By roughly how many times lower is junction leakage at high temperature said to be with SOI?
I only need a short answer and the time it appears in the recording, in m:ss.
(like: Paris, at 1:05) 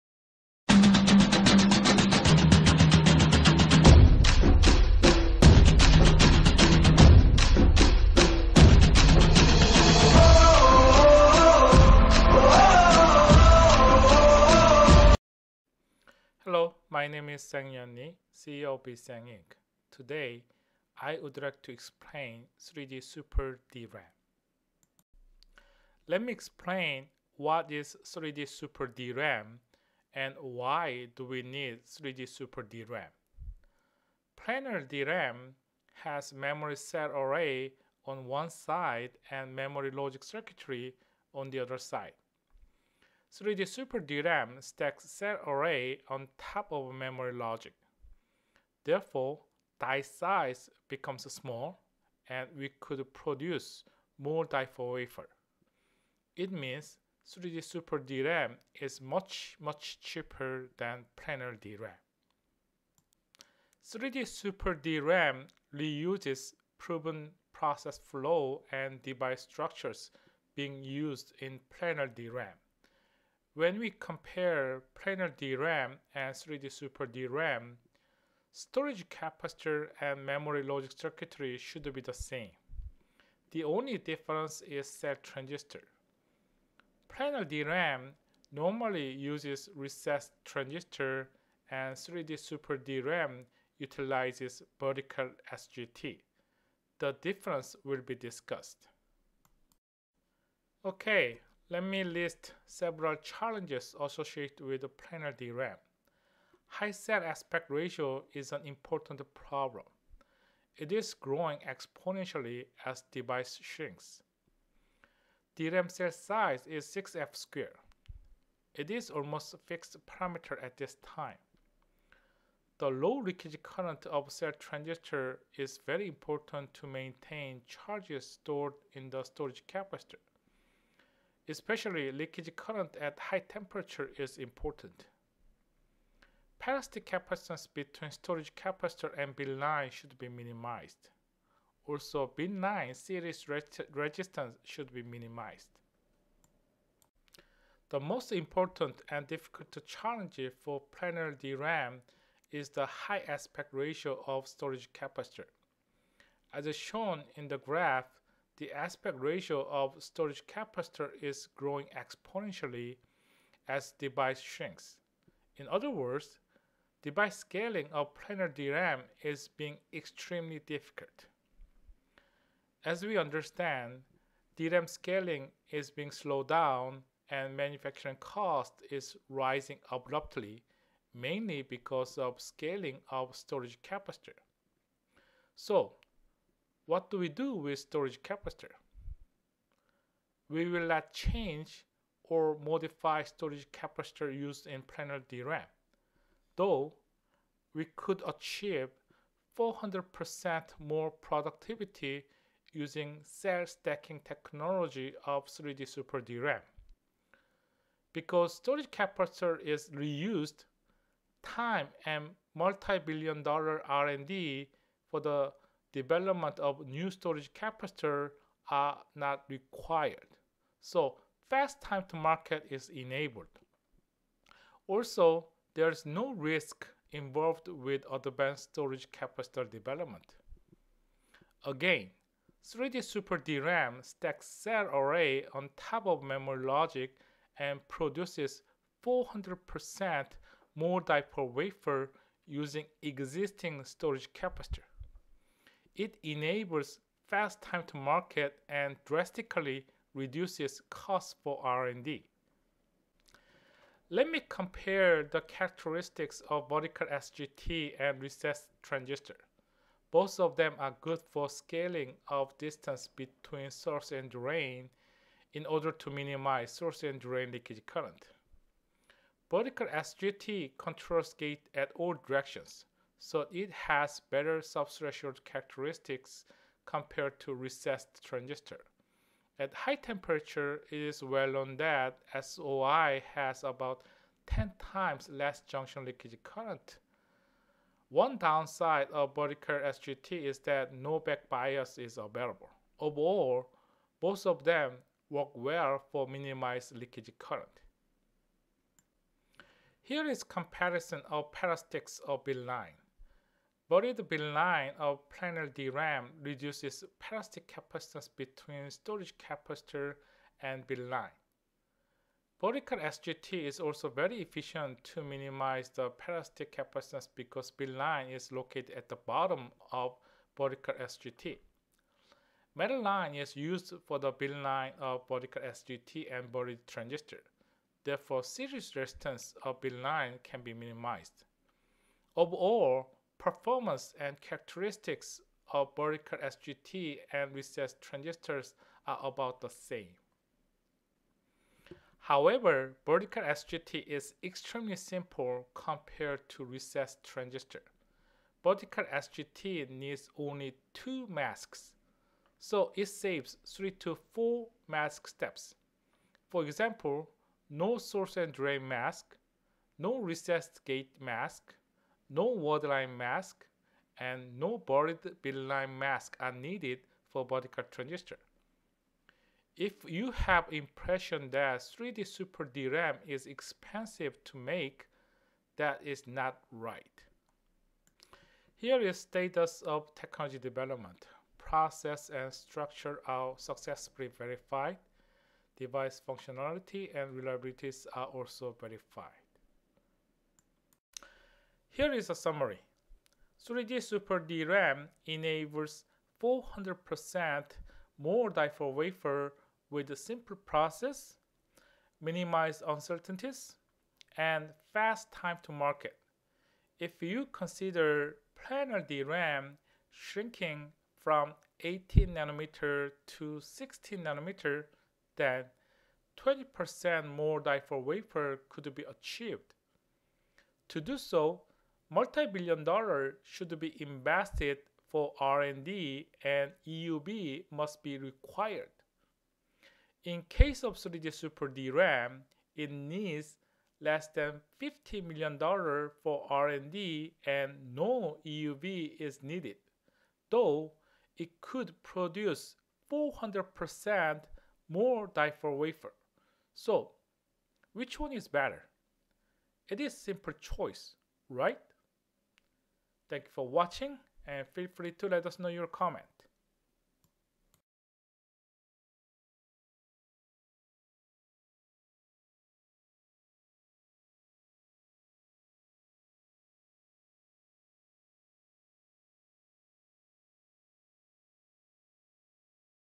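10 times, at 4:44.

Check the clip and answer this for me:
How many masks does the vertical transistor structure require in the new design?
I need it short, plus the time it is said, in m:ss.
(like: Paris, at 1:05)
2, at 5:50.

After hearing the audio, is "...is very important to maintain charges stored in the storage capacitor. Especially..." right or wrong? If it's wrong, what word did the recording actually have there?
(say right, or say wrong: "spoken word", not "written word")
right.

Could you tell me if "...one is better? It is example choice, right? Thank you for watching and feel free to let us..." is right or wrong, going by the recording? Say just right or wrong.
wrong.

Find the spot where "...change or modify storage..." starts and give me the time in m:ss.
3:11.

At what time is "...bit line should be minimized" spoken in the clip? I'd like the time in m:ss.
2:19.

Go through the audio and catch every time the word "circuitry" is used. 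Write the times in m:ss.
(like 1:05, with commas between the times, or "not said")
0:40, 1:20.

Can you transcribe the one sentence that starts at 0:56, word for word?
It means 3D Super DRAM is much, much cheaper than planar DRAM.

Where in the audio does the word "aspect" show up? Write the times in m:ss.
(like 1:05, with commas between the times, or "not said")
1:47, 2:33, 2:38.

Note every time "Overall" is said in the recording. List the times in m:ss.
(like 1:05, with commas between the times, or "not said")
4:52, 5:32.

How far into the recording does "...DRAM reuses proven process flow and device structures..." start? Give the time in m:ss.
1:04.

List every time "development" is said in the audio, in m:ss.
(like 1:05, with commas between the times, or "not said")
3:35, 3:49, 6:20.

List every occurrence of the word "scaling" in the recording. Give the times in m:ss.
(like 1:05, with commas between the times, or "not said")
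2:47, 2:54, 3:02, 4:21.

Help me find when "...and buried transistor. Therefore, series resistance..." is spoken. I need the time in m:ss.
5:26.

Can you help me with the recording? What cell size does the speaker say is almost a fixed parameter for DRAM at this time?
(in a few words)
6F square.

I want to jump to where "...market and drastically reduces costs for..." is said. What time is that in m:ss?
4:07.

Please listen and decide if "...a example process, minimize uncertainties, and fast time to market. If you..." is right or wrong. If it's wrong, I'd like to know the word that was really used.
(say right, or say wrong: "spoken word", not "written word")
wrong: "simple", not "example".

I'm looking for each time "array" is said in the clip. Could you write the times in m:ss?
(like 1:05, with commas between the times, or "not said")
0:37, 0:45, 3:54.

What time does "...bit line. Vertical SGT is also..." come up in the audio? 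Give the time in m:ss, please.
5:10.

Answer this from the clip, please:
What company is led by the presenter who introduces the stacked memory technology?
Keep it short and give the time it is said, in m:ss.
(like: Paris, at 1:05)
BeSang Inc., at 0:18.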